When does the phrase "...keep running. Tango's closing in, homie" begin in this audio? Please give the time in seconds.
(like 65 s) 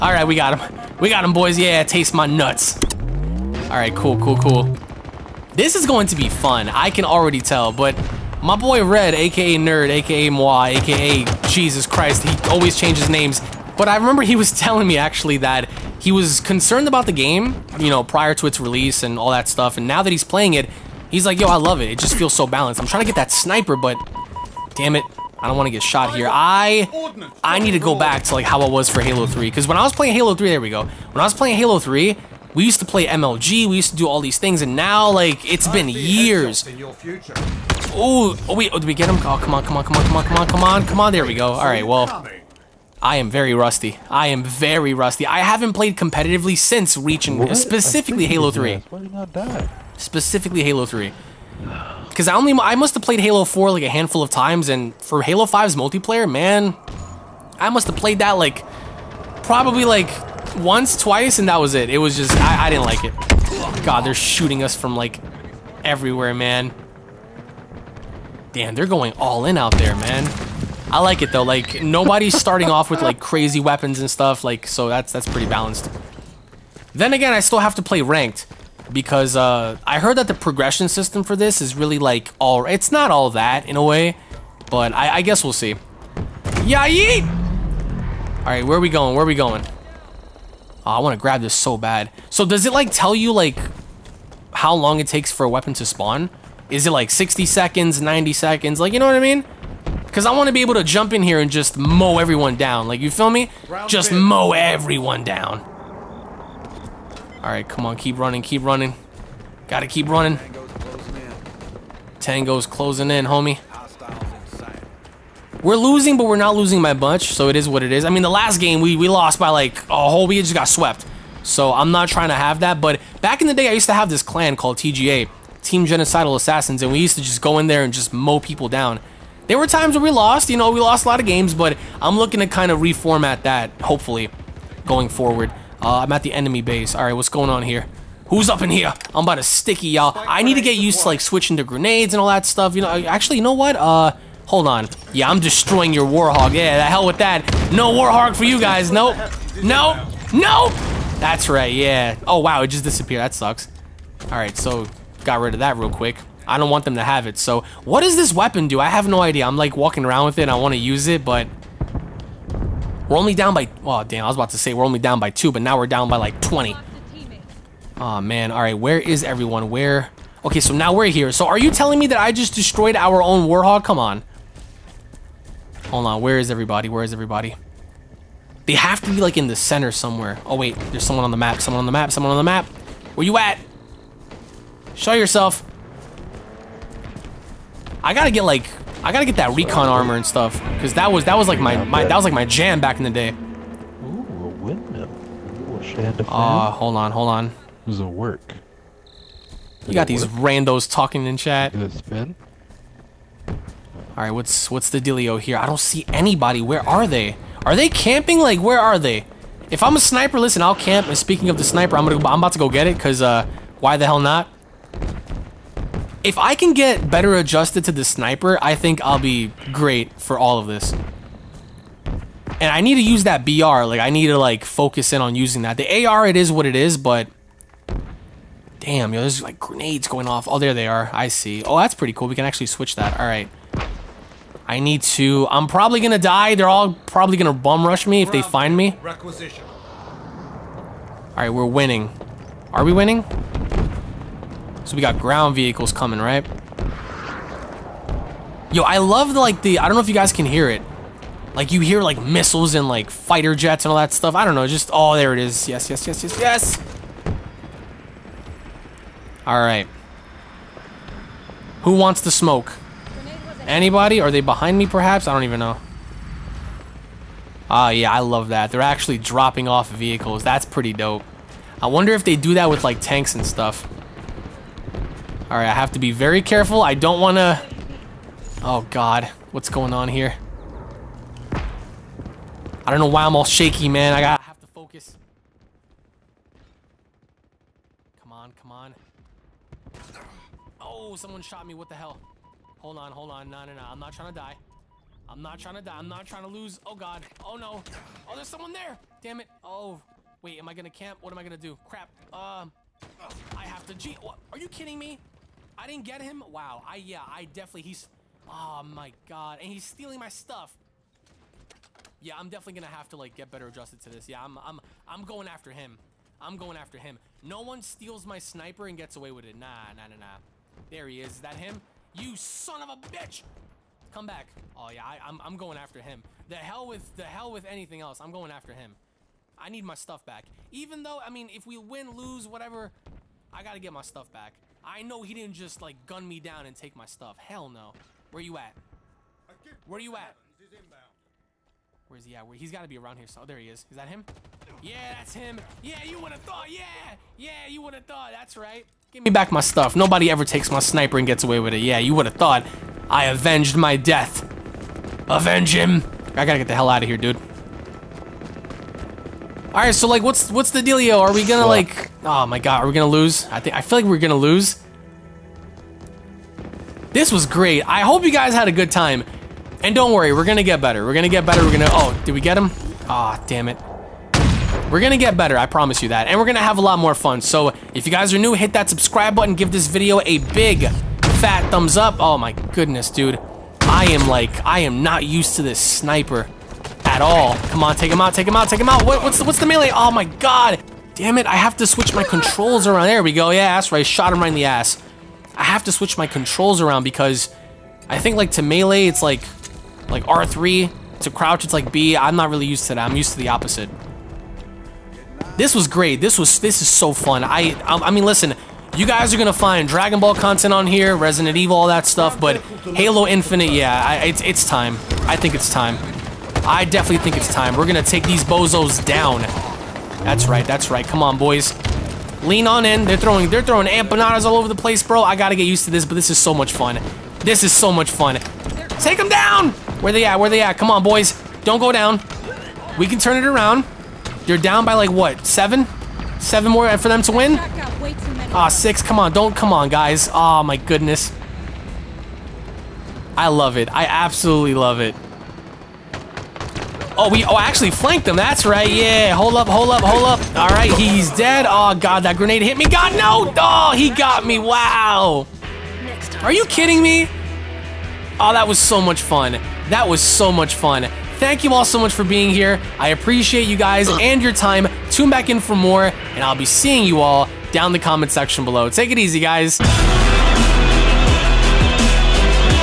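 109 s.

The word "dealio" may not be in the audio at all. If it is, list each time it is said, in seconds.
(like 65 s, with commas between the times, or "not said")
205 s, 360 s.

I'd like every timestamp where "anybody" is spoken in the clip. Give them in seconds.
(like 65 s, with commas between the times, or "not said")
206 s, 263 s.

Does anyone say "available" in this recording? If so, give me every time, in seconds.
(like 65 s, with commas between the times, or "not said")
not said.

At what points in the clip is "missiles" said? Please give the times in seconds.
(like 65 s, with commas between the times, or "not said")
252 s.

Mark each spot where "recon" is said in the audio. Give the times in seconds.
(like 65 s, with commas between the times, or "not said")
189 s.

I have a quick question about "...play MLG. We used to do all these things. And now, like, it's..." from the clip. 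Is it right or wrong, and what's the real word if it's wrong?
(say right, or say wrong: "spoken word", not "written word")
right.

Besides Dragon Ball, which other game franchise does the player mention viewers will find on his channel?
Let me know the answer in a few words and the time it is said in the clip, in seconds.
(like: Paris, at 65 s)
Resident Evil, at 411 s.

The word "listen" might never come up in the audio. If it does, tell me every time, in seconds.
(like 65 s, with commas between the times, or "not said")
210 s, 408 s.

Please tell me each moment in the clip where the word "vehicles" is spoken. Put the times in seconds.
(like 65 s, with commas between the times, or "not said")
245 s, 269 s.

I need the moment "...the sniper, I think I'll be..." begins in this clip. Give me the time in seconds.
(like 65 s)
217 s.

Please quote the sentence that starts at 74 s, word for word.
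Like so that's that's pretty balanced.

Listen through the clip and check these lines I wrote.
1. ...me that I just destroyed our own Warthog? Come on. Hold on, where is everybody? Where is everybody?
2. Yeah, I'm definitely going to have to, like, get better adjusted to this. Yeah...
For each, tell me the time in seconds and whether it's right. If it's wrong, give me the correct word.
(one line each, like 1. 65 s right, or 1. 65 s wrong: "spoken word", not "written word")
1. 171 s right
2. 312 s right.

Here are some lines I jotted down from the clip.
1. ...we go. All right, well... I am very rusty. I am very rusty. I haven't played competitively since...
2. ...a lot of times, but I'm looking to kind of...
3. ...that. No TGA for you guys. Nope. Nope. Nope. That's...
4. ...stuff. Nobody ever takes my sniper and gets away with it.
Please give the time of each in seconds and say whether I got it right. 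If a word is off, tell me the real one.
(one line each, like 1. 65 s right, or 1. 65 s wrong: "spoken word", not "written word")
1. 41 s right
2. 131 s wrong: "games", not "times"
3. 147 s wrong: "Warthog", not "TGA"
4. 349 s right.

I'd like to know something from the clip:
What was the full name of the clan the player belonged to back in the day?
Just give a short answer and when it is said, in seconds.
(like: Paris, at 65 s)
Team Genocidal Assassins, at 125 s.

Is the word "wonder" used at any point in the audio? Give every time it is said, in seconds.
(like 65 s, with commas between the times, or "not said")
271 s.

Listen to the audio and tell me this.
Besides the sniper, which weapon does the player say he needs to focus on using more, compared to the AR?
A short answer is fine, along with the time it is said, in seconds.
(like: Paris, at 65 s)
BR, at 223 s.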